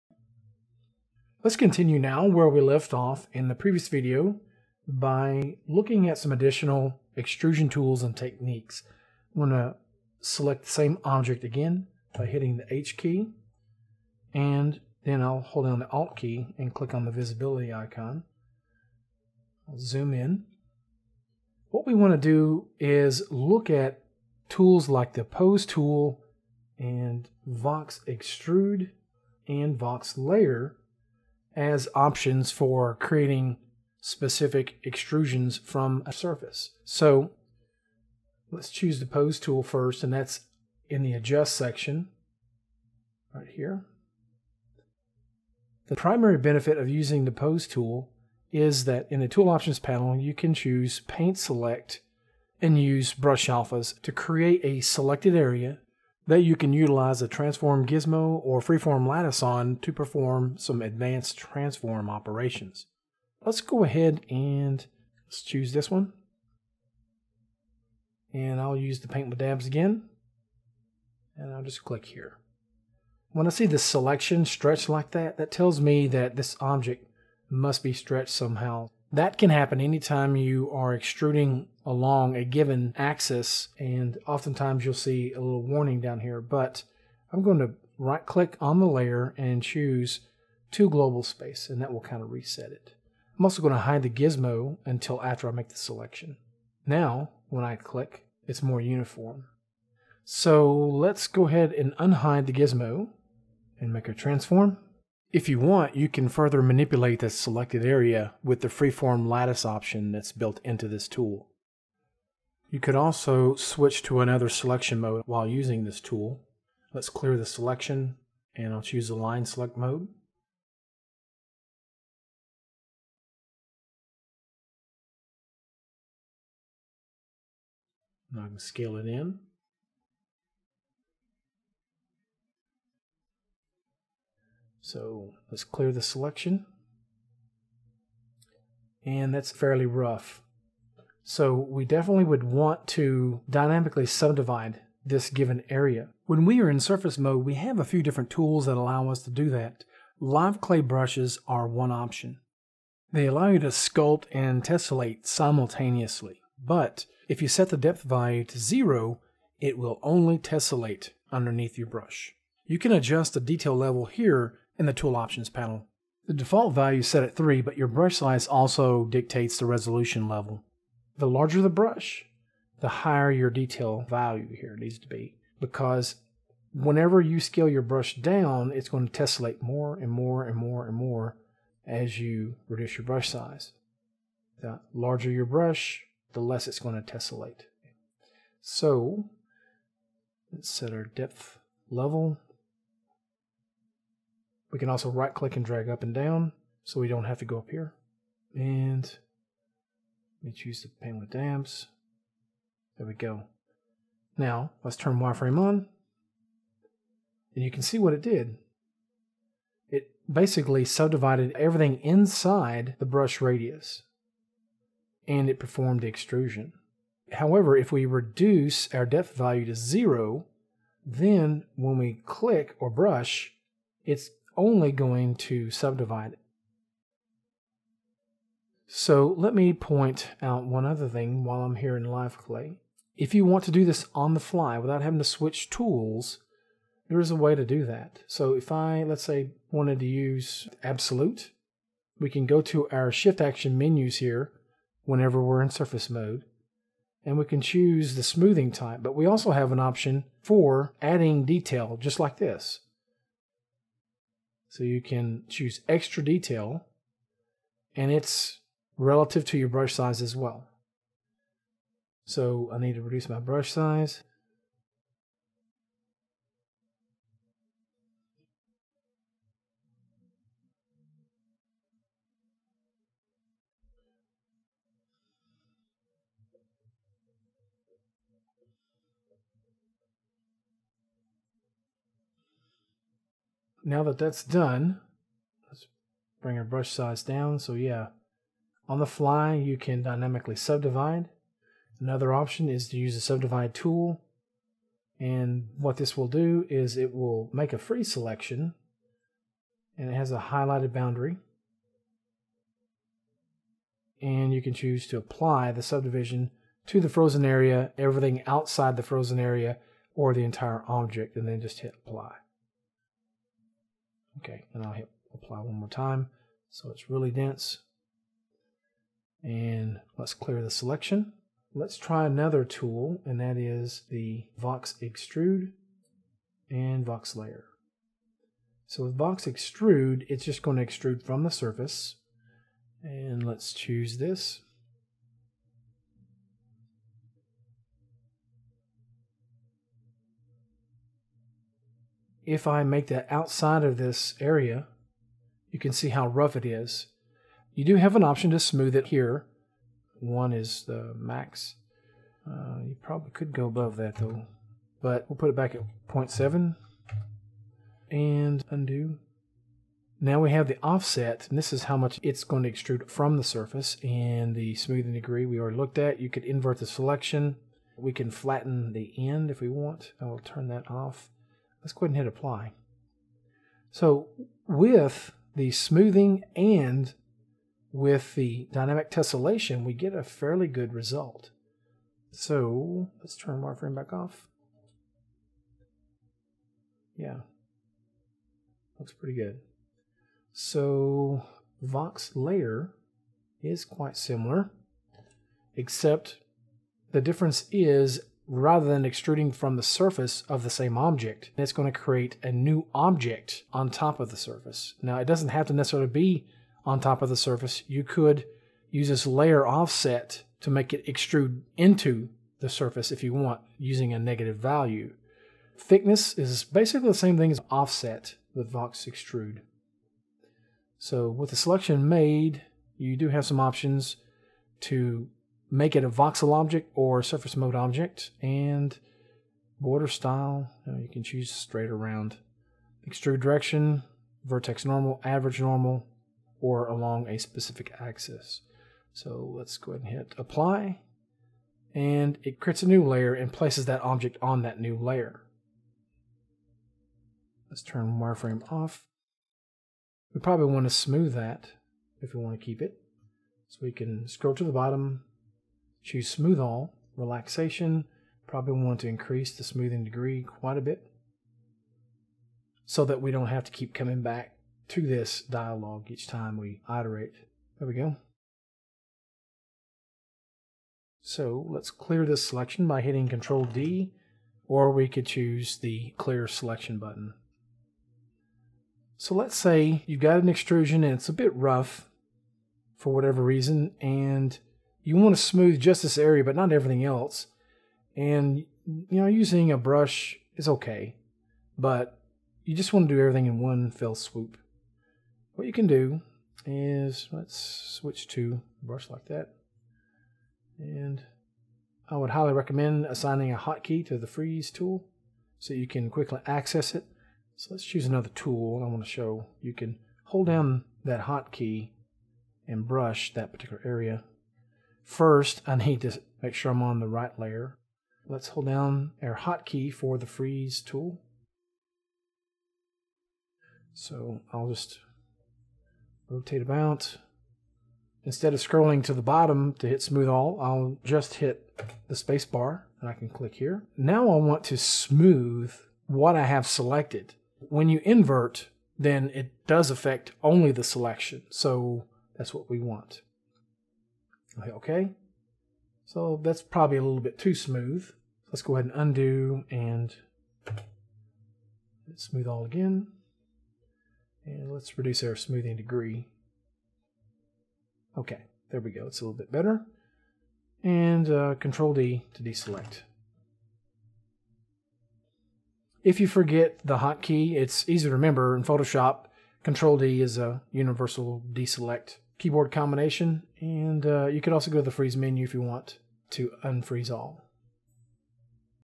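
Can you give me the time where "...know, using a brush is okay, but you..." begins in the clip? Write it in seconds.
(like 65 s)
489 s.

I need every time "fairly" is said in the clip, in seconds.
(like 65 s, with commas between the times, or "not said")
139 s, 380 s.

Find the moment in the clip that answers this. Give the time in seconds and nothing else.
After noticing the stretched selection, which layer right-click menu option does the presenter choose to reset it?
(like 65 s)
90 s.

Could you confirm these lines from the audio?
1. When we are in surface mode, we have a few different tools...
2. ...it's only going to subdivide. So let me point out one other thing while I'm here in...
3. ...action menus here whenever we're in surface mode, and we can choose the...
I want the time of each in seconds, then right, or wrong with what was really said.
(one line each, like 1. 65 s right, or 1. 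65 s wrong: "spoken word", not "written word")
1. 146 s right
2. 224 s right
3. 243 s right.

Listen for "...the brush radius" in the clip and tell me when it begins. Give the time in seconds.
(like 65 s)
212 s.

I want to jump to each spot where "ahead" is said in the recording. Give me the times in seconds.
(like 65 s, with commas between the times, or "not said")
63 s, 101 s, 372 s, 439 s, 548 s.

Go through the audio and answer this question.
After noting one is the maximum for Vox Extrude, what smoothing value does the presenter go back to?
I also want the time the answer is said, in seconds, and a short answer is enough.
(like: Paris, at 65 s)
0.7, at 356 s.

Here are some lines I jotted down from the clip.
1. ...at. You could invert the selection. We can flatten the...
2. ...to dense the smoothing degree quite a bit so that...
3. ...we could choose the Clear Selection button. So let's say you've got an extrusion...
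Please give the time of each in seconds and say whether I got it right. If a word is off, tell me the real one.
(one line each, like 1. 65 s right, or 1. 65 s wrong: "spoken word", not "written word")
1. 365 s right
2. 459 s wrong: "increase", not "dense"
3. 474 s right.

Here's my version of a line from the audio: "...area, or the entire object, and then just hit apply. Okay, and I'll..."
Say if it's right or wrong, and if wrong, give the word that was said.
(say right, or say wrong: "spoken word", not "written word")
right.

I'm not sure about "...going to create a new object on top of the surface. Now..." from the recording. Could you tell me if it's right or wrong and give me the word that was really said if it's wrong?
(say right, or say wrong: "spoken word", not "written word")
right.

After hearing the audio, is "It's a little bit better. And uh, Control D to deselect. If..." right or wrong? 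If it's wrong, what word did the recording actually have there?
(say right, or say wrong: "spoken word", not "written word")
right.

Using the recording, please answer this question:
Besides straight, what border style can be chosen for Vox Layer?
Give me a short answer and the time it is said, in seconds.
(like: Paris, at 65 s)
round, at 431 s.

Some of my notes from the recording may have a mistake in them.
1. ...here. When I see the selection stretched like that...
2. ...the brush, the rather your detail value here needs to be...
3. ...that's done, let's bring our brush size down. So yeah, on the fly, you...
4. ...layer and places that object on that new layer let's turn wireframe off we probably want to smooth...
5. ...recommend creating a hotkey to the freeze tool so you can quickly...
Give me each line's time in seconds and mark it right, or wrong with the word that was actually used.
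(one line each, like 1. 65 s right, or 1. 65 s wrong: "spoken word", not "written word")
1. 72 s right
2. 171 s wrong: "higher", not "rather"
3. 284 s right
4. 443 s right
5. 502 s wrong: "assigning", not "creating".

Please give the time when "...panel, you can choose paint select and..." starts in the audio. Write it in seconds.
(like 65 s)
49 s.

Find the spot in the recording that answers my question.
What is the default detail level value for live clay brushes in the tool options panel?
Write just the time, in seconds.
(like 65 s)
167 s.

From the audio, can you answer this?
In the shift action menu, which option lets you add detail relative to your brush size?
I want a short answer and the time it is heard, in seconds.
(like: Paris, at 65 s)
extra detail, at 255 s.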